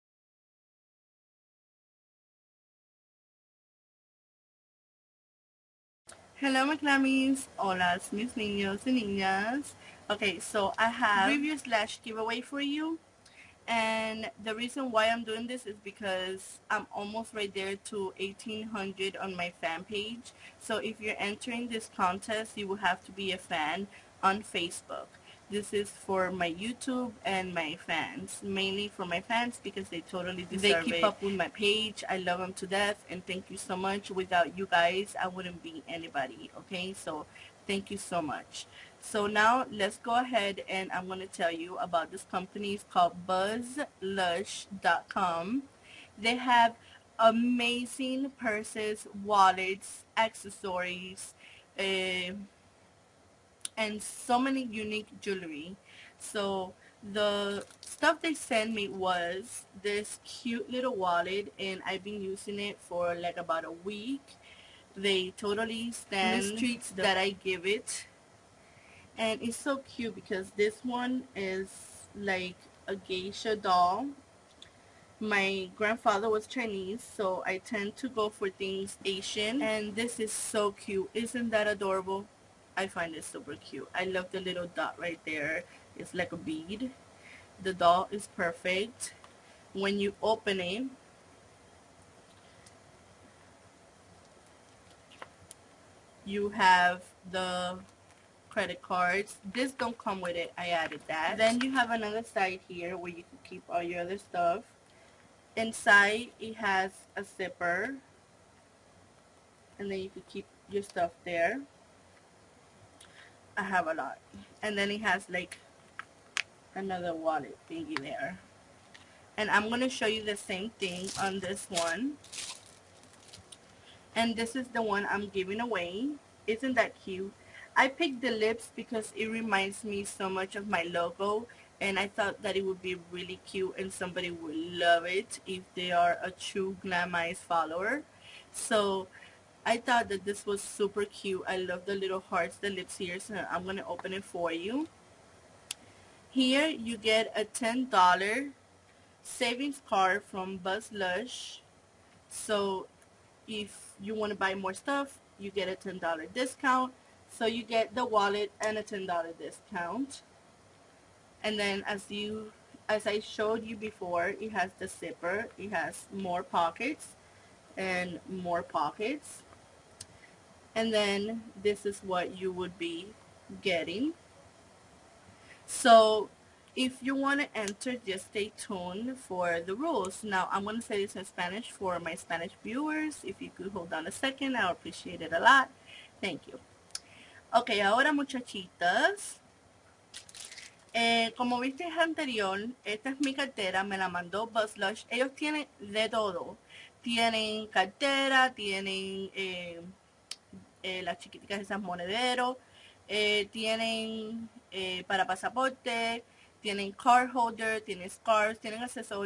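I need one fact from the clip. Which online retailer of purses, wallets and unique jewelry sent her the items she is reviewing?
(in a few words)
buzzlush.com.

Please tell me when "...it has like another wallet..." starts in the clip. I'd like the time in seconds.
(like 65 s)
114 s.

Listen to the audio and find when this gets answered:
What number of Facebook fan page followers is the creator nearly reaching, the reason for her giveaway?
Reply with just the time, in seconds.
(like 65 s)
18 s.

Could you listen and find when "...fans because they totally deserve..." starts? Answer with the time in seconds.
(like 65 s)
29 s.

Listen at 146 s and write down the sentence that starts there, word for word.
Here you get a $10 savings card from Buzz Lush.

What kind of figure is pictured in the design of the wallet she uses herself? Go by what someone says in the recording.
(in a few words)
geisha doll.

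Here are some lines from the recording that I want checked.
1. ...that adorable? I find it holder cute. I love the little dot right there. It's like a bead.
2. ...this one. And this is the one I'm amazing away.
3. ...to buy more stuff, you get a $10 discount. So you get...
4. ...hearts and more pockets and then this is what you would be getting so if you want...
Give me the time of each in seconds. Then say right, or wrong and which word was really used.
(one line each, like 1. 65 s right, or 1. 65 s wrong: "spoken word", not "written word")
1. 81 s wrong: "super", not "holder"
2. 121 s wrong: "giving", not "amazing"
3. 154 s right
4. 166 s wrong: "pockets", not "hearts".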